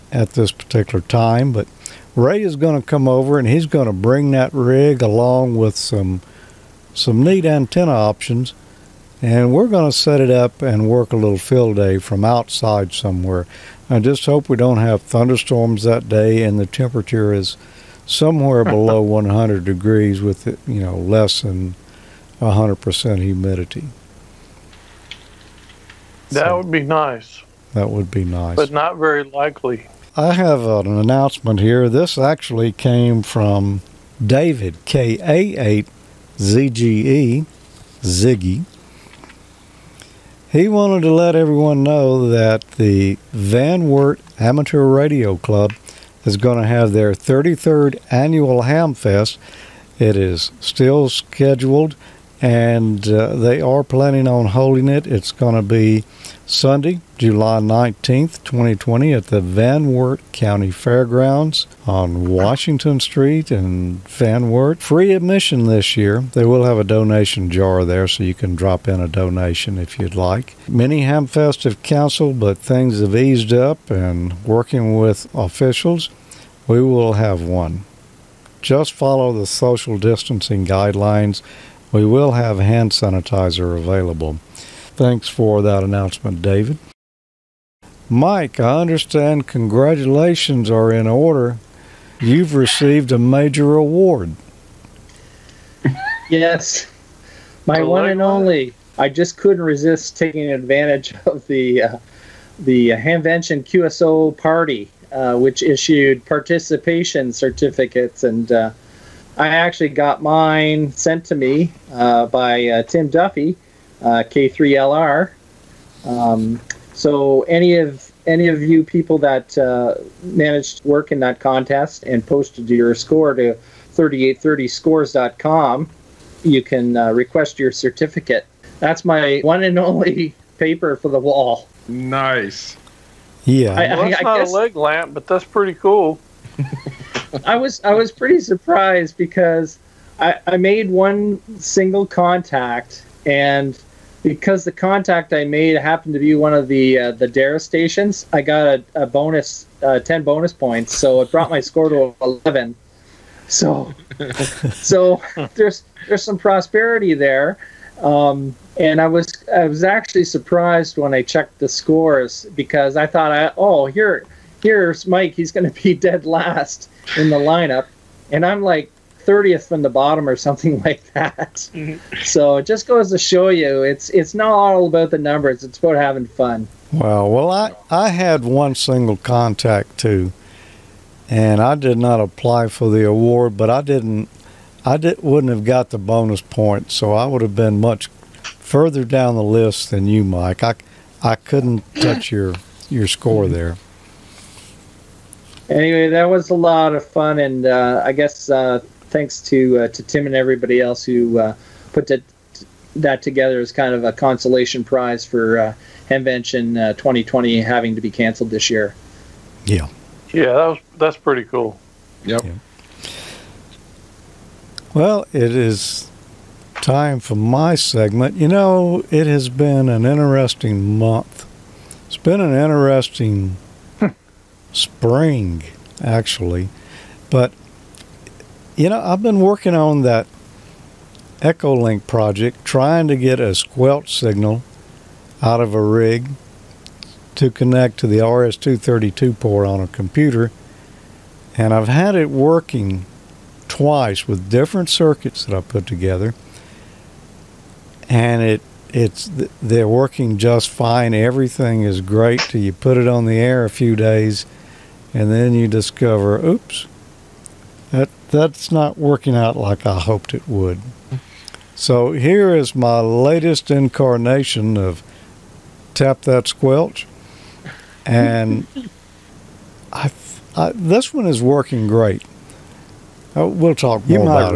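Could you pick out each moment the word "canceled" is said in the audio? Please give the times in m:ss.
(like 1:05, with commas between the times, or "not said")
1:11, 3:28.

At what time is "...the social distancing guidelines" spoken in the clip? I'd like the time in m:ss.
1:19.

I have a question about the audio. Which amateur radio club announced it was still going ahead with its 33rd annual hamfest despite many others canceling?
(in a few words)
Van Wert Amateur Radio Club.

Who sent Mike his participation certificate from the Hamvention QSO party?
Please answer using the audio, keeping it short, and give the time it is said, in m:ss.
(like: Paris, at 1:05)
Tim Duffy, at 1:52.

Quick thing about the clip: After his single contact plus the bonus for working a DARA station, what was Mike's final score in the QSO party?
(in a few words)
11.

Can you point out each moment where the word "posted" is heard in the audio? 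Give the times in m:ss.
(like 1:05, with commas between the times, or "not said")
2:02.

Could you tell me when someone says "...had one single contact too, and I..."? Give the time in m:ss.
2:58.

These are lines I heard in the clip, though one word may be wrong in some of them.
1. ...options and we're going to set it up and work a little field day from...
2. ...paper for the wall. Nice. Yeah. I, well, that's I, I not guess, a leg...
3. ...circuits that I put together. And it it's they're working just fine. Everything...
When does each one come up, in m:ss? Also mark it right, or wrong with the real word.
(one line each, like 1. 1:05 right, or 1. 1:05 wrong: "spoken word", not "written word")
1. 0:07 right
2. 2:10 right
3. 4:04 right.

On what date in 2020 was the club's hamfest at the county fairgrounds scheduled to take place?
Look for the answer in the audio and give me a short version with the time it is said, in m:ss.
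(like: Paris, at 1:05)
Sunday, July 19th, at 0:56.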